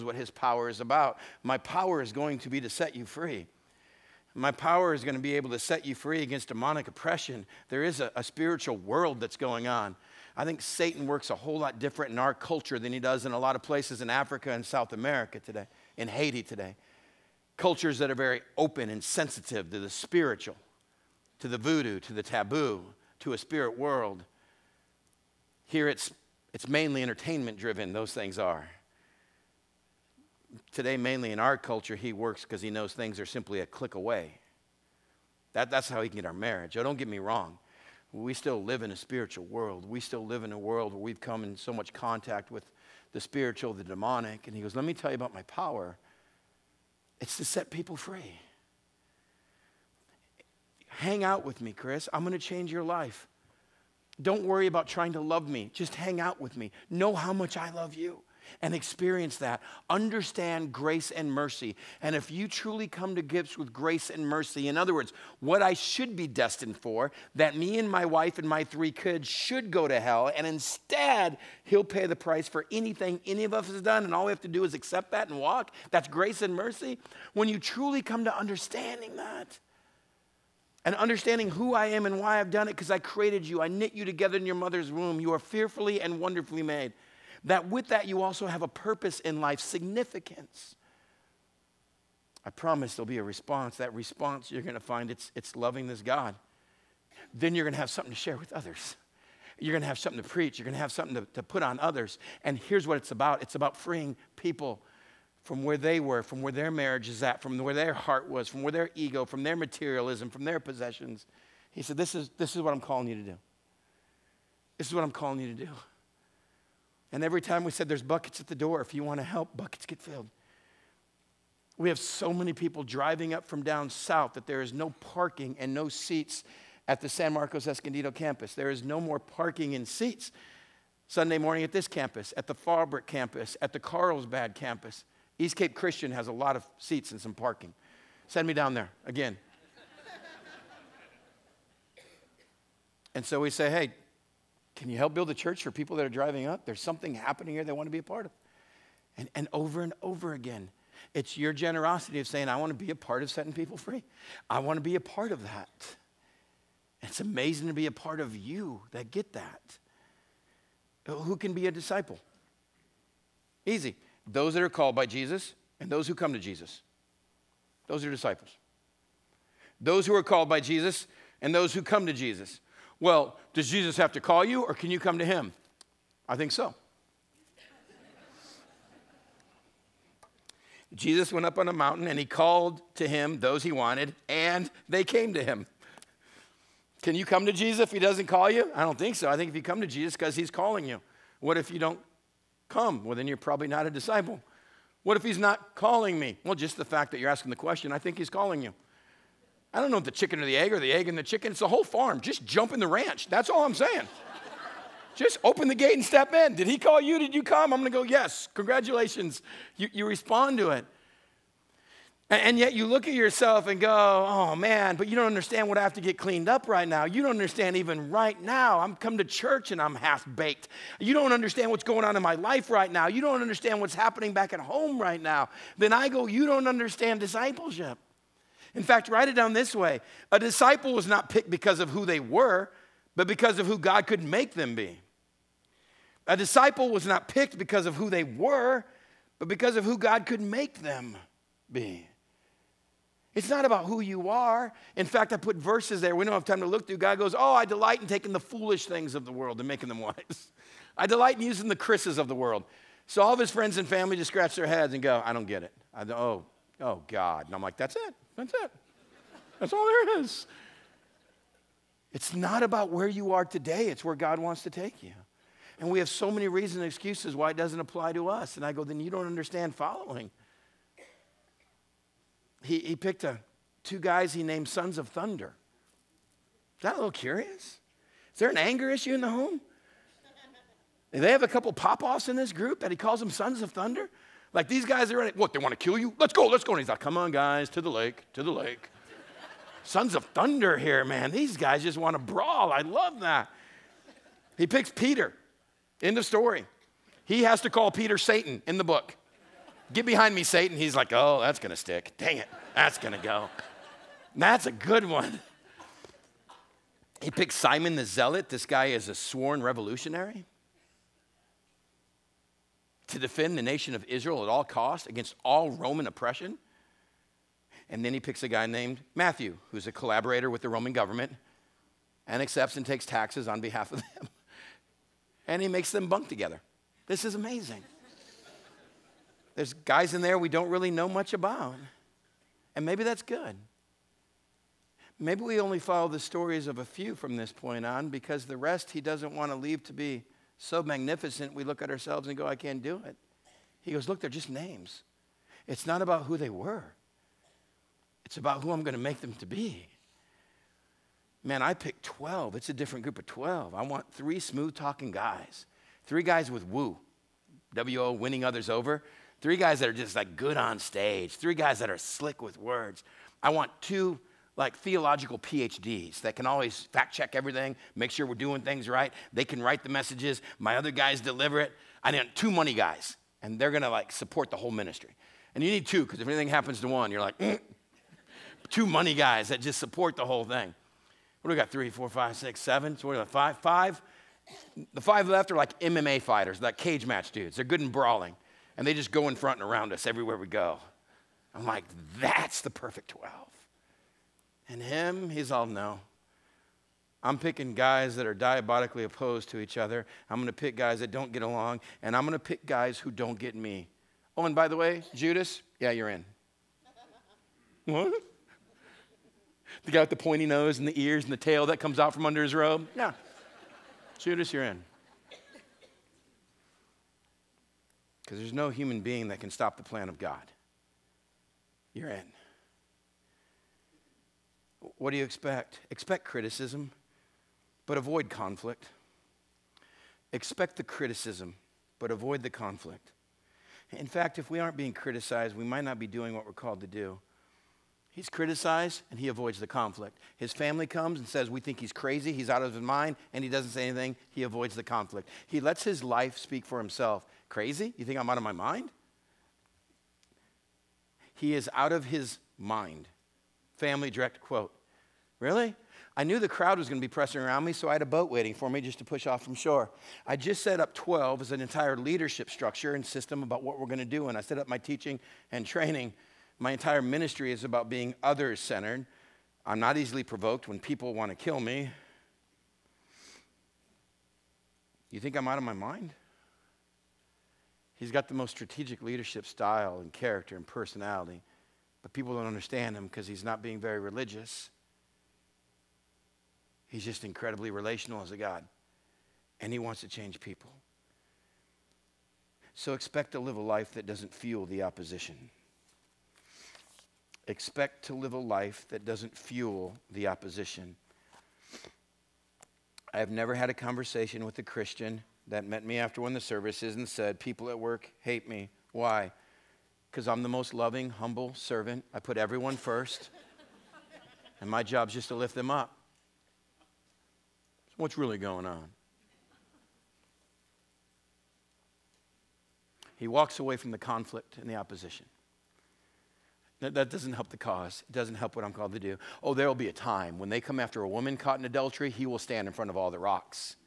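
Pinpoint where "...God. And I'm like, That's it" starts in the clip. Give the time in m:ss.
4:17.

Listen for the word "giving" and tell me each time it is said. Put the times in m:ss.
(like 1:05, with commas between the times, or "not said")
not said.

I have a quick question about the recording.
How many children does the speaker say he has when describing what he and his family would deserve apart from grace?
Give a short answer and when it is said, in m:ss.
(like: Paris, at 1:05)
3, at 1:08.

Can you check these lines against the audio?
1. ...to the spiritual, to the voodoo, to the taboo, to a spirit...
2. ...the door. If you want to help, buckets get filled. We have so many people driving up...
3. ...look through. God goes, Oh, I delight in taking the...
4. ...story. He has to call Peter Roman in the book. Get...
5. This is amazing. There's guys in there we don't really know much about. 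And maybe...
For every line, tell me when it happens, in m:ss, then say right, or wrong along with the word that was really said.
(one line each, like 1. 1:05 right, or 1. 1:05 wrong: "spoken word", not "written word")
1. 0:19 right
2. 1:58 right
3. 4:06 right
4. 4:56 wrong: "Satan", not "Roman"
5. 5:27 right.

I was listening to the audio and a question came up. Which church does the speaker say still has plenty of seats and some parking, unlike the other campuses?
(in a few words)
East Cape Christian.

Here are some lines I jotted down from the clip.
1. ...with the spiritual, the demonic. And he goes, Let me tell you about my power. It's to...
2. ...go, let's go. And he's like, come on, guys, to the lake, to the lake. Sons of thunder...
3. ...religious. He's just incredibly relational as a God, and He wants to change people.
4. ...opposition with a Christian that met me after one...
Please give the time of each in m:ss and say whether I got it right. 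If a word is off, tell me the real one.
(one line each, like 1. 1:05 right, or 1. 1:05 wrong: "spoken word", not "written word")
1. 0:42 right
2. 4:46 right
3. 8:03 right
4. 8:23 wrong: "conversation", not "opposition".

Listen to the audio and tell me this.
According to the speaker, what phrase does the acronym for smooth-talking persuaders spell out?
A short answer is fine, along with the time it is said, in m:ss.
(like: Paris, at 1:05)
Winning others over, at 5:58.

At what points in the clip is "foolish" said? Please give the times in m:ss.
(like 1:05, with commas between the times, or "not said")
4:08.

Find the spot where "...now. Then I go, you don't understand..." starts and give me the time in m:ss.
3:45.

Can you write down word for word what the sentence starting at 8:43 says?
He walks away from the conflict and the opposition.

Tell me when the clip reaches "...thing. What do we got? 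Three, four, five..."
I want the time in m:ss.
6:20.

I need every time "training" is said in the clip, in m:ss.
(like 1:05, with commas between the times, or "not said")
7:45.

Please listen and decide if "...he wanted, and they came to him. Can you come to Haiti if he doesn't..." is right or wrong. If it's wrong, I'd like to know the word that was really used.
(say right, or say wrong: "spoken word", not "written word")
wrong: "Jesus", not "Haiti".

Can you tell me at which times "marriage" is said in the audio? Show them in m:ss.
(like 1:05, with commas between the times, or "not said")
0:36, 1:46.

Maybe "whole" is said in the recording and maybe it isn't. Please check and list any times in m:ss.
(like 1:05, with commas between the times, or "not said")
0:11, 3:21, 6:14, 6:20.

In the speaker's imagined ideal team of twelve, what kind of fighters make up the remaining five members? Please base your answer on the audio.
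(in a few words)
MMA fighters.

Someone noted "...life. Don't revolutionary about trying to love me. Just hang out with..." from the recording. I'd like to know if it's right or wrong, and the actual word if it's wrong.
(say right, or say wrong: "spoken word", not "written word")
wrong: "worry", not "revolutionary".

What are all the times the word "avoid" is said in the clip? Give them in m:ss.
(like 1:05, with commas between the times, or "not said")
7:07, 7:12, 7:19, 7:24.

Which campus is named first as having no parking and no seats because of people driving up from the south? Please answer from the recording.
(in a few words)
San Marcos Escondido.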